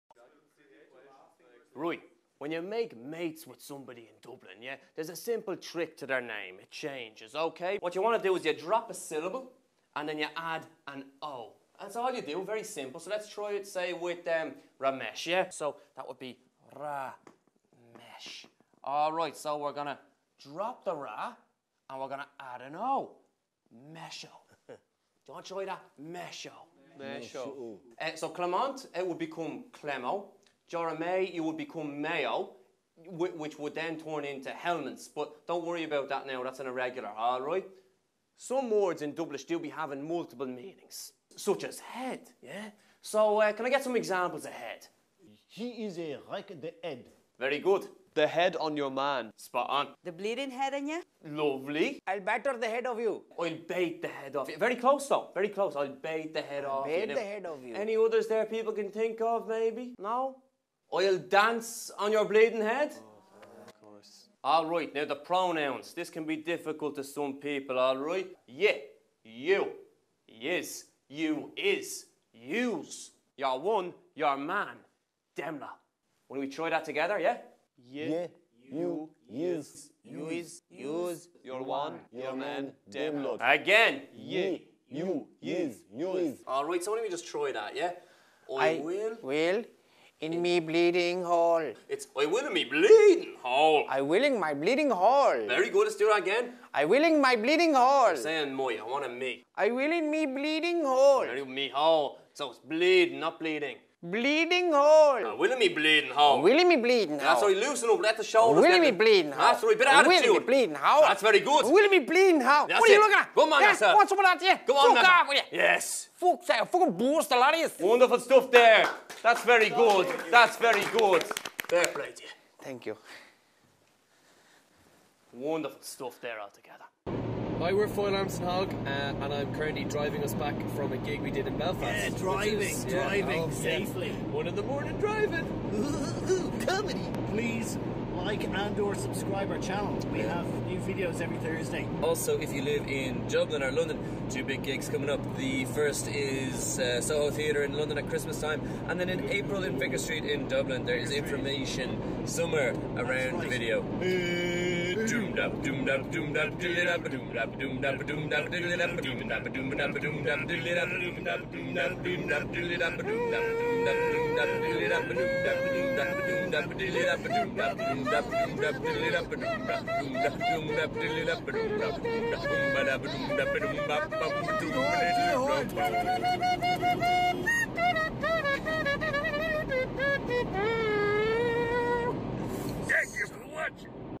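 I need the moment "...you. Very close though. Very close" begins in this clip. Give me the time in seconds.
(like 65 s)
54 s.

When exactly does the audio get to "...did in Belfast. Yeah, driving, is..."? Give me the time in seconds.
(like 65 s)
131 s.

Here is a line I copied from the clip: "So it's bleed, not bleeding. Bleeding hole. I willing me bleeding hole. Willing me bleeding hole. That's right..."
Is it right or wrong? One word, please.
right.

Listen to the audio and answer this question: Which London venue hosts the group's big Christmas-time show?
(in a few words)
Soho Theatre.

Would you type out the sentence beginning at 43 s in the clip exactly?
So uh, can I get some examples of head?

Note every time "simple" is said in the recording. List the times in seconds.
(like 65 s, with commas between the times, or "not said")
5 s, 12 s.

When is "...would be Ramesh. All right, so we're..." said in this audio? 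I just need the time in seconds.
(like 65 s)
16 s.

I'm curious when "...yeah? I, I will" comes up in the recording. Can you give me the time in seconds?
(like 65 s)
87 s.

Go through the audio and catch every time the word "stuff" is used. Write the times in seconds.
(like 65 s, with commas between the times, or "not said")
118 s, 125 s.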